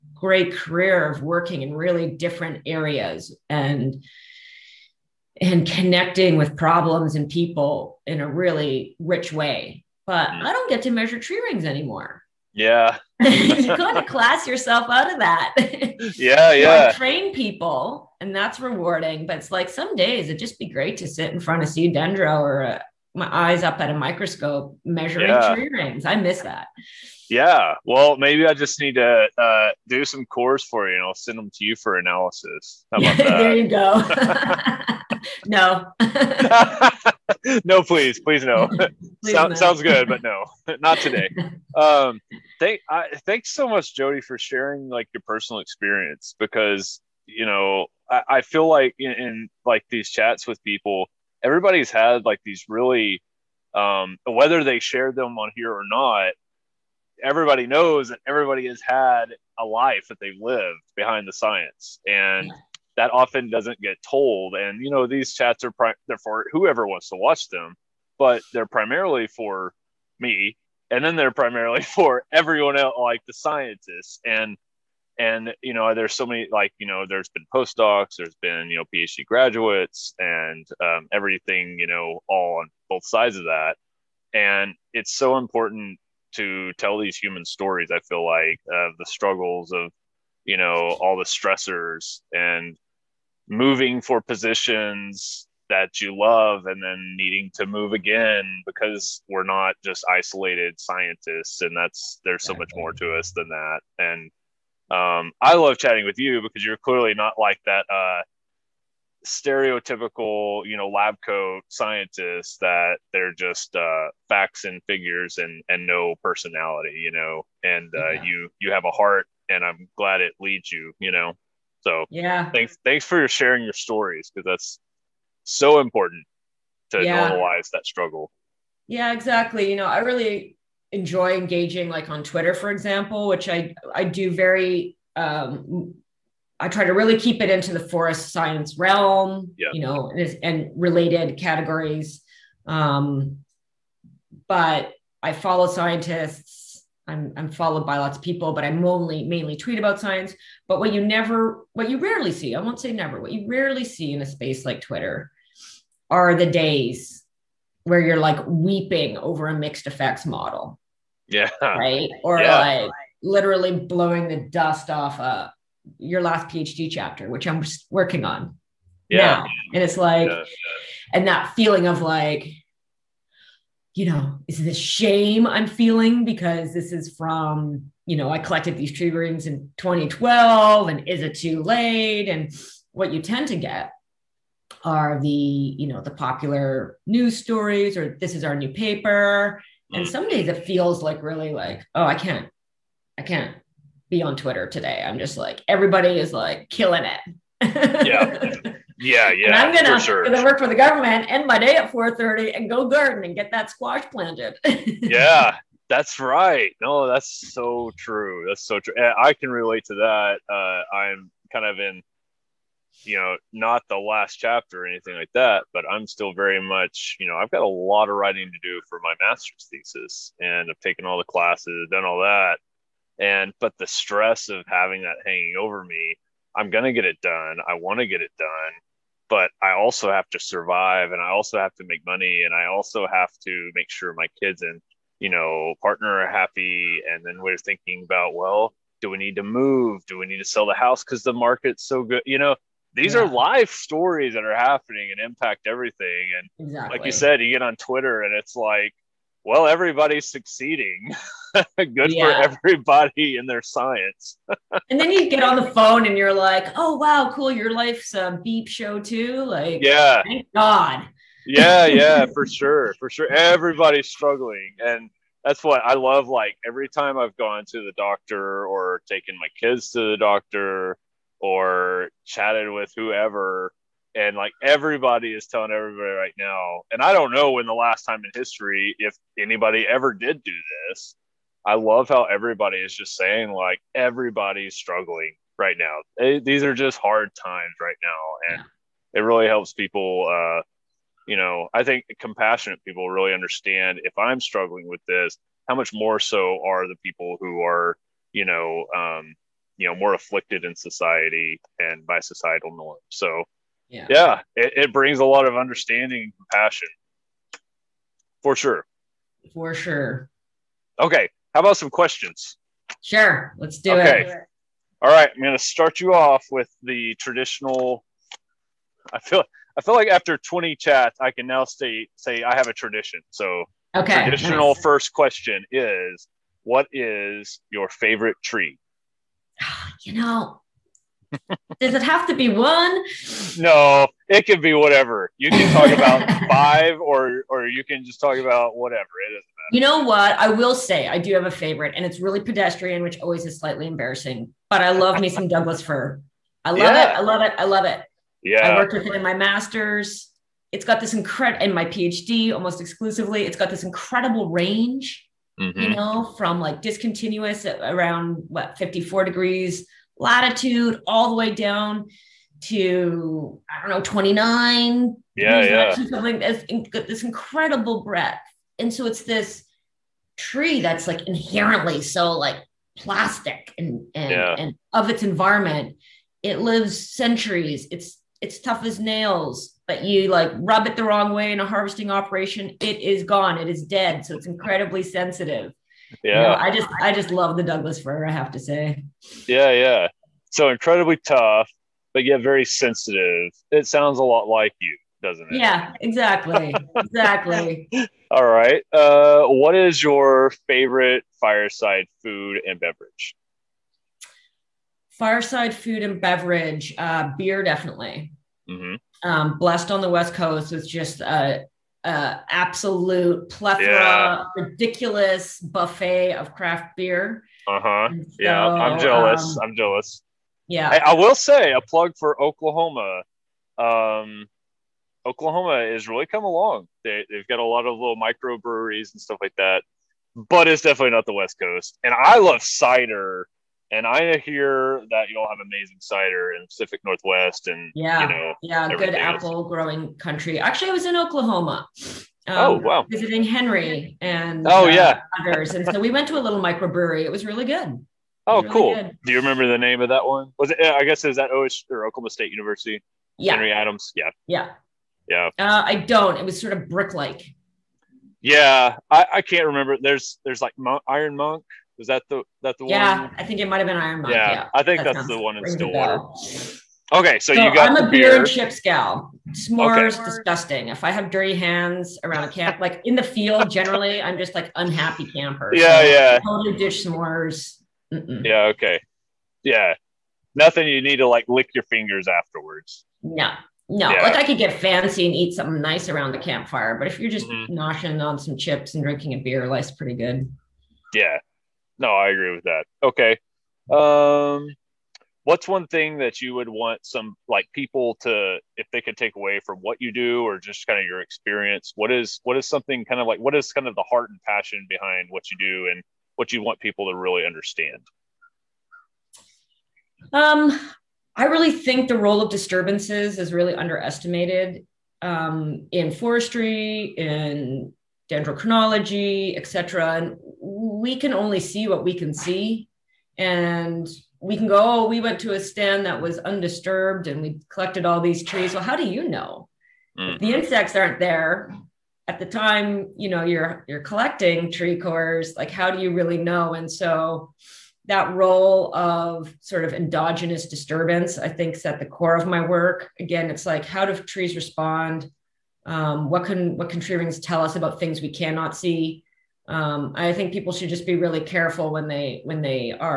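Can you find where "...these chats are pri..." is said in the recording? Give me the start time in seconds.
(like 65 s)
65 s.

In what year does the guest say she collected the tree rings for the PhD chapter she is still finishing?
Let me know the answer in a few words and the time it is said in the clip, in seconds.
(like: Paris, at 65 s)
2012, at 179 s.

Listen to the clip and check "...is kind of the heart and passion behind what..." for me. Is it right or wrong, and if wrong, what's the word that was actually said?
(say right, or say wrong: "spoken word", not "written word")
right.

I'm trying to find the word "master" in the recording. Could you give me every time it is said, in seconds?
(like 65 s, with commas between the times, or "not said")
219 s, 349 s.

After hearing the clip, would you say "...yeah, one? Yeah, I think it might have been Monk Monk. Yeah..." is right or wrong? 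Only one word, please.
wrong.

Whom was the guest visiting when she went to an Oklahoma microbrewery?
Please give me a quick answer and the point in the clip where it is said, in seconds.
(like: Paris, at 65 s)
Henry Adams, at 453 s.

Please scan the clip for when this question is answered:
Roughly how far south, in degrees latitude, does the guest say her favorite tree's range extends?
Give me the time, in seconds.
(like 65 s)
364 s.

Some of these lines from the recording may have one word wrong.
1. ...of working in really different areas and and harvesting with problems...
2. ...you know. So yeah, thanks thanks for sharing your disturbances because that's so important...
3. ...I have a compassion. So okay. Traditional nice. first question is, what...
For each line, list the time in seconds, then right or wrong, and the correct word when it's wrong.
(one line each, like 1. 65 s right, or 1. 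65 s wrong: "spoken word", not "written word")
1. 1 s wrong: "connecting", not "harvesting"
2. 120 s wrong: "stories", not "disturbances"
3. 322 s wrong: "tradition", not "compassion".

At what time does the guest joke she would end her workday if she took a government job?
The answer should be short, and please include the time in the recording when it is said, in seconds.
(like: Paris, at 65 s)
4:30, at 201 s.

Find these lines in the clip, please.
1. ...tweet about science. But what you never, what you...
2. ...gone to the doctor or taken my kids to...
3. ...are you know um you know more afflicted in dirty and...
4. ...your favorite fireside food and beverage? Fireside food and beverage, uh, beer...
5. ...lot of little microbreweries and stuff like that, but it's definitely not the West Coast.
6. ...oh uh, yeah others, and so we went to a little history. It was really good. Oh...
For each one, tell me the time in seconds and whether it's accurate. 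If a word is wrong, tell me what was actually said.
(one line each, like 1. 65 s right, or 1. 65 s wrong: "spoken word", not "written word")
1. 149 s right
2. 267 s right
3. 297 s wrong: "society", not "dirty"
4. 400 s right
5. 427 s right
6. 444 s wrong: "microbrewery", not "history".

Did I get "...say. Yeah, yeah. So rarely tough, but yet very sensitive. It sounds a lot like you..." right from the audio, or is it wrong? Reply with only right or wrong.
wrong.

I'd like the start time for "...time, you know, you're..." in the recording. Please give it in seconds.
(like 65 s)
532 s.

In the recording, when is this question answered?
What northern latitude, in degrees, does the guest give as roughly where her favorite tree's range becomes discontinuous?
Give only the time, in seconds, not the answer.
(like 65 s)
358 s.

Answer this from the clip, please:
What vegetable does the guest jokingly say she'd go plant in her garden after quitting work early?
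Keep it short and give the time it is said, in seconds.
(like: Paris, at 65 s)
squash, at 203 s.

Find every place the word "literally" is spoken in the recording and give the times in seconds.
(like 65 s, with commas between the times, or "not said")
163 s.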